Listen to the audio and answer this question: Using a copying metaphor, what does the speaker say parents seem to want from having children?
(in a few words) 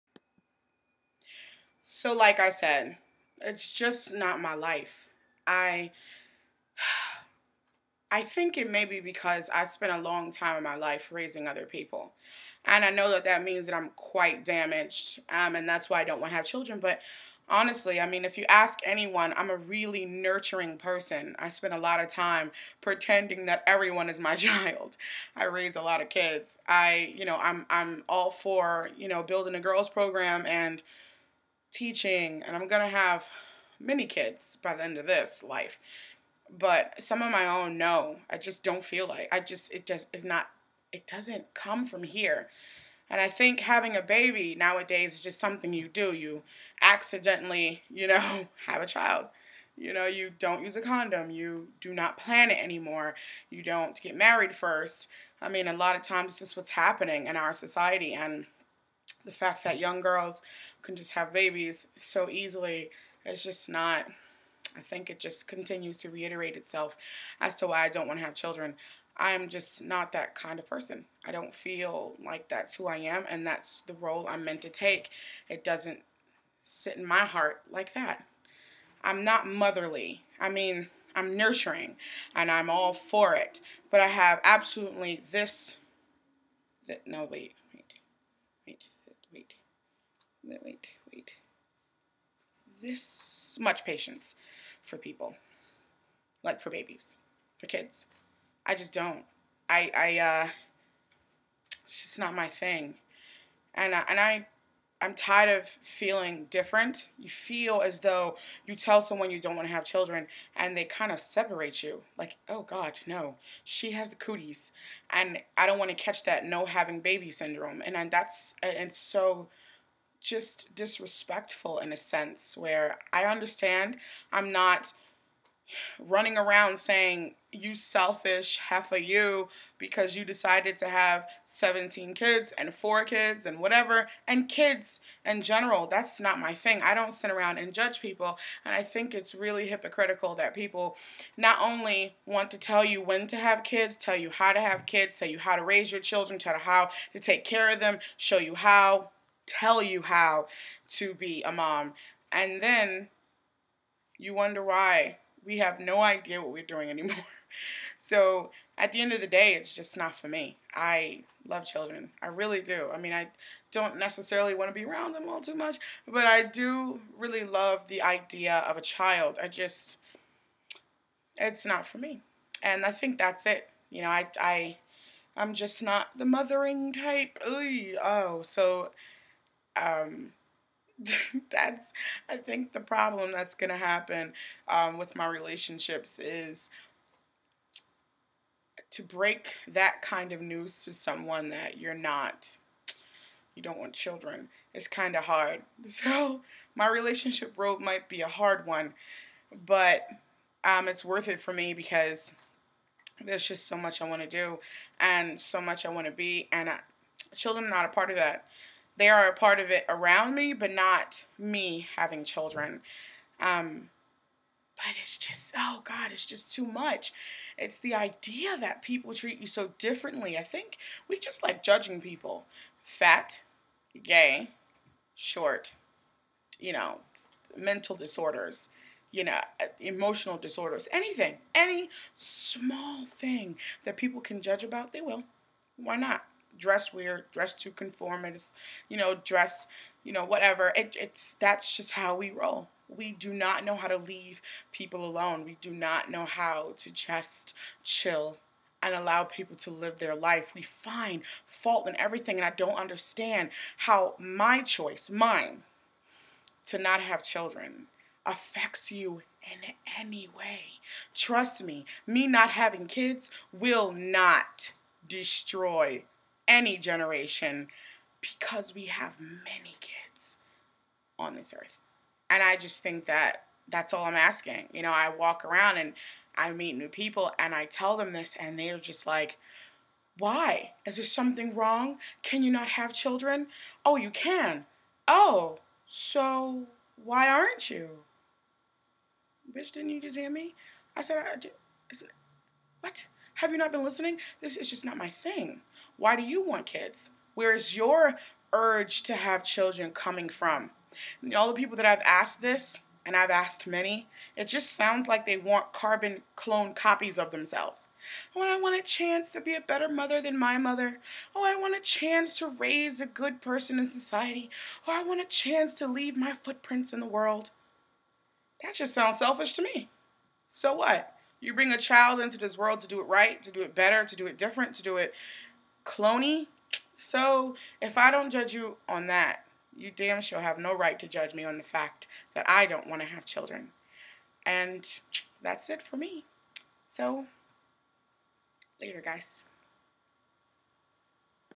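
carbon clone copies.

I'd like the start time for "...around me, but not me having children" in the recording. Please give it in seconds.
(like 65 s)
209 s.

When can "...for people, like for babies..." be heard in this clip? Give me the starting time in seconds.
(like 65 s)
94 s.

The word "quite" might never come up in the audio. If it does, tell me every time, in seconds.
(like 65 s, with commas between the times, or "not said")
13 s.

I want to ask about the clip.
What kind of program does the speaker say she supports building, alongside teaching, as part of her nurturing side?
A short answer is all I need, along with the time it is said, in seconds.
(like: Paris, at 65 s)
girls program, at 29 s.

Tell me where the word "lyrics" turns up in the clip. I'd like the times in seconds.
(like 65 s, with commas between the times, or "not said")
not said.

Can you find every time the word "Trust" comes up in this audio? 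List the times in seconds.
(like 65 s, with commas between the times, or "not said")
261 s.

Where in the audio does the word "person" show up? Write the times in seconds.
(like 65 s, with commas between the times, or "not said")
20 s, 70 s, 313 s.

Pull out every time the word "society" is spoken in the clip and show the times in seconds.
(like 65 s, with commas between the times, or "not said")
57 s, 313 s.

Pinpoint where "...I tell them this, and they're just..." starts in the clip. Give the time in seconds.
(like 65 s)
277 s.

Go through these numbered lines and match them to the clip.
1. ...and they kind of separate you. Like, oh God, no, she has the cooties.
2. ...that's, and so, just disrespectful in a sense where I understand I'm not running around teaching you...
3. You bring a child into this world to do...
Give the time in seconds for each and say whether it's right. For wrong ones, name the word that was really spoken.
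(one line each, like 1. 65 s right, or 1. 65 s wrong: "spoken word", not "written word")
1. 110 s right
2. 118 s wrong: "saying", not "teaching"
3. 321 s right.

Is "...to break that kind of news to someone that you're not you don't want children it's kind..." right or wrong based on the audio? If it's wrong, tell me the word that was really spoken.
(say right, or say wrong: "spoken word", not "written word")
right.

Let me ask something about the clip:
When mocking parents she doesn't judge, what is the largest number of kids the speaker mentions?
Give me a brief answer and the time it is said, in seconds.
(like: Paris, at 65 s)
17, at 131 s.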